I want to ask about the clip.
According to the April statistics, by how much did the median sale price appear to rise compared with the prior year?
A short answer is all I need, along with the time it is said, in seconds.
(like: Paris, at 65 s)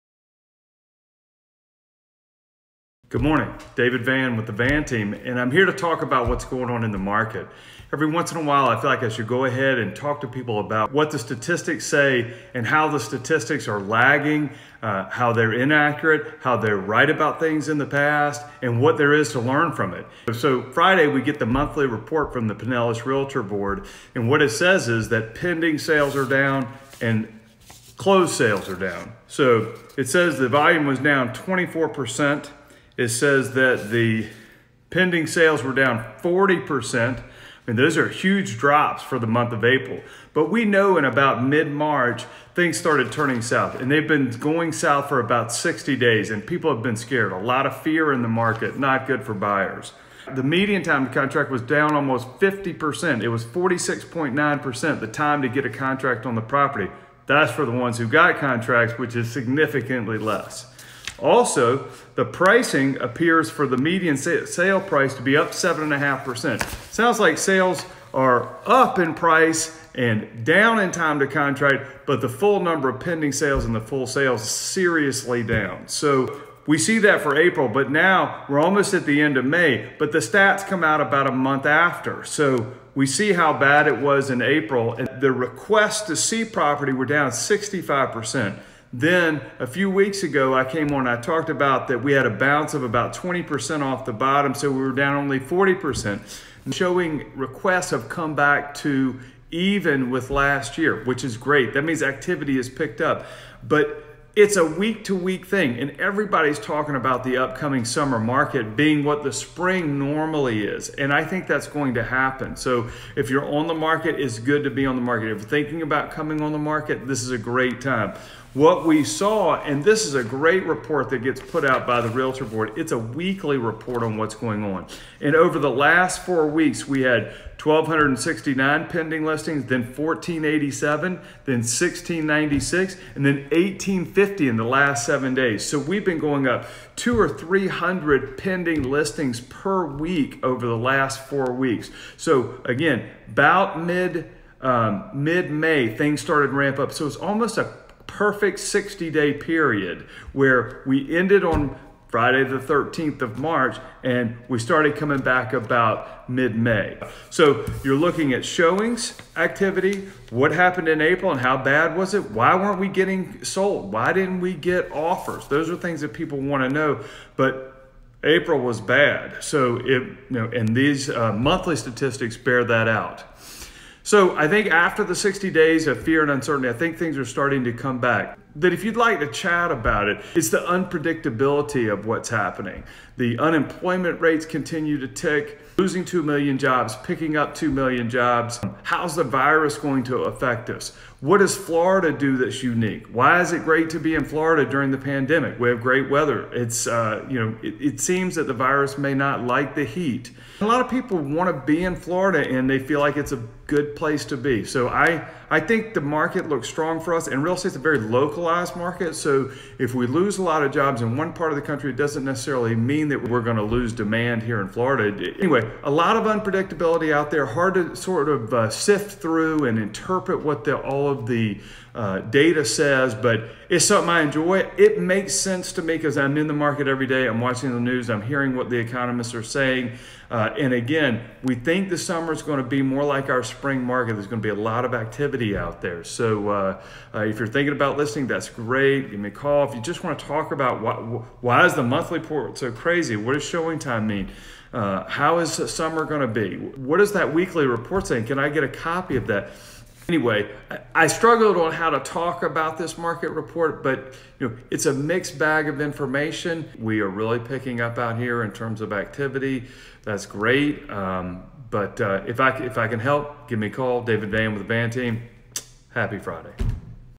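7.5%, at 65 s.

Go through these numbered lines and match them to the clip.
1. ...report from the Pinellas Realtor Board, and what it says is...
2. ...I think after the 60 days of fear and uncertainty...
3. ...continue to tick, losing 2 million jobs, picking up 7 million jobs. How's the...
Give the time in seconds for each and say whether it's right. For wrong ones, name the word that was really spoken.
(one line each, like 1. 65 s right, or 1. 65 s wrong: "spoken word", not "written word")
1. 21 s right
2. 174 s right
3. 184 s wrong: "2", not "7".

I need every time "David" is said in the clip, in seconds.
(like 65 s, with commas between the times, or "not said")
3 s, 264 s.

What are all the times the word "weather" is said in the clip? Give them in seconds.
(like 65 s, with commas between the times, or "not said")
196 s.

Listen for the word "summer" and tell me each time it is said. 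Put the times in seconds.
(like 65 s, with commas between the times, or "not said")
107 s, 231 s, 245 s.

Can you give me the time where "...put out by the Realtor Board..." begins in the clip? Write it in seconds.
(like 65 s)
121 s.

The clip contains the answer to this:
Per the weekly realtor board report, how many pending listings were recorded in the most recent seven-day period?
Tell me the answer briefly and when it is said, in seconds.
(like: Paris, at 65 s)
1,850, at 133 s.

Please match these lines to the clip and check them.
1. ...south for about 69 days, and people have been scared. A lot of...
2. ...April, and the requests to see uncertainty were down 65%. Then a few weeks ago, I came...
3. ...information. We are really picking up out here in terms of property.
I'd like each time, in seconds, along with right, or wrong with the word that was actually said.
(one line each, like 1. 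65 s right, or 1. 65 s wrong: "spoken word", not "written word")
1. 44 s wrong: "60", not "69"
2. 84 s wrong: "property", not "uncertainty"
3. 255 s wrong: "activity", not "property".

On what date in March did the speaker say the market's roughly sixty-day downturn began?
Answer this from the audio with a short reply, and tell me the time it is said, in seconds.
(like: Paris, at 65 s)
Friday the 13th, at 152 s.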